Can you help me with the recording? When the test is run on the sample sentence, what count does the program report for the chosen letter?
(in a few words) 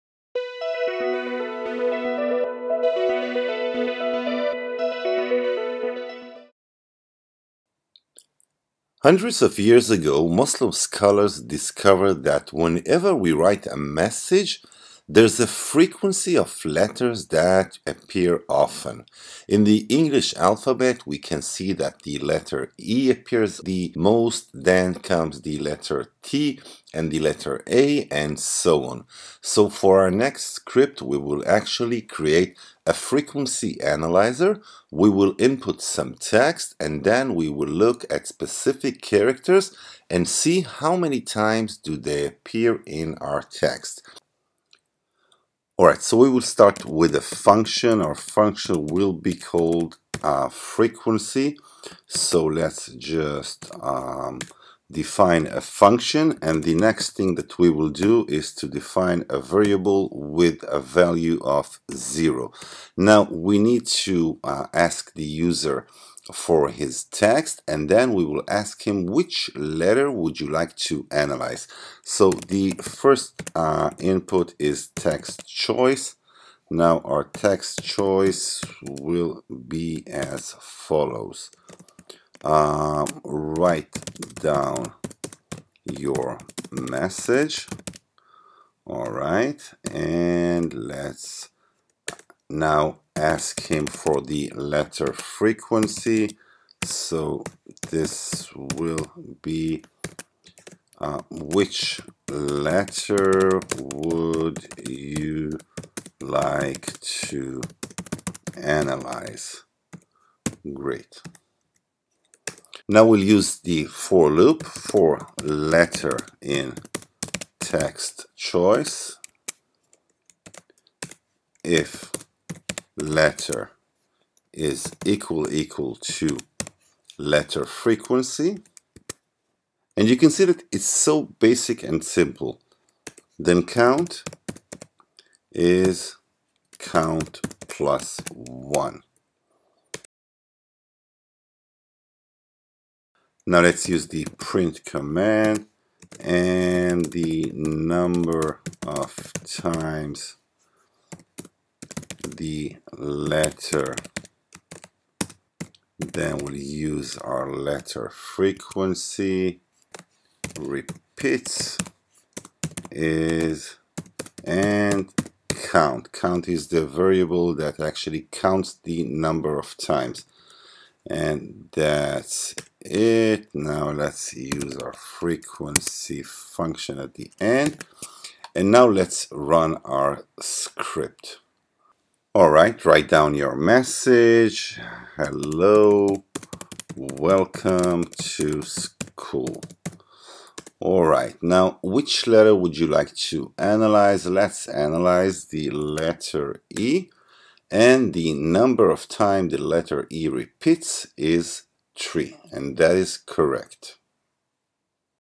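3.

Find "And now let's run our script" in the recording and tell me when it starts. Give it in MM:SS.
02:58.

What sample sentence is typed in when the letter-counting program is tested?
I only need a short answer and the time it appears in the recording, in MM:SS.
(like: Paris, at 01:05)
Hello, welcome to school, at 03:05.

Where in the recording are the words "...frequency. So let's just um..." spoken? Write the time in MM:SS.
00:50.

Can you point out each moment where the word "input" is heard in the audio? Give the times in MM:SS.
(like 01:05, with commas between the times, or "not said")
00:35, 01:13.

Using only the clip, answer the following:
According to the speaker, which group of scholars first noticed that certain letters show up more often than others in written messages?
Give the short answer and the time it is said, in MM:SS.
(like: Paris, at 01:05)
Muslim scholars, at 00:10.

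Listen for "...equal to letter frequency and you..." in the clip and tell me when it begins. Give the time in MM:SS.
02:05.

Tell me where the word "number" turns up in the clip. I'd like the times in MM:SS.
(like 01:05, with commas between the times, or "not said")
02:27, 02:49, 03:18.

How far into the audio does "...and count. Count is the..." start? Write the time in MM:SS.
02:44.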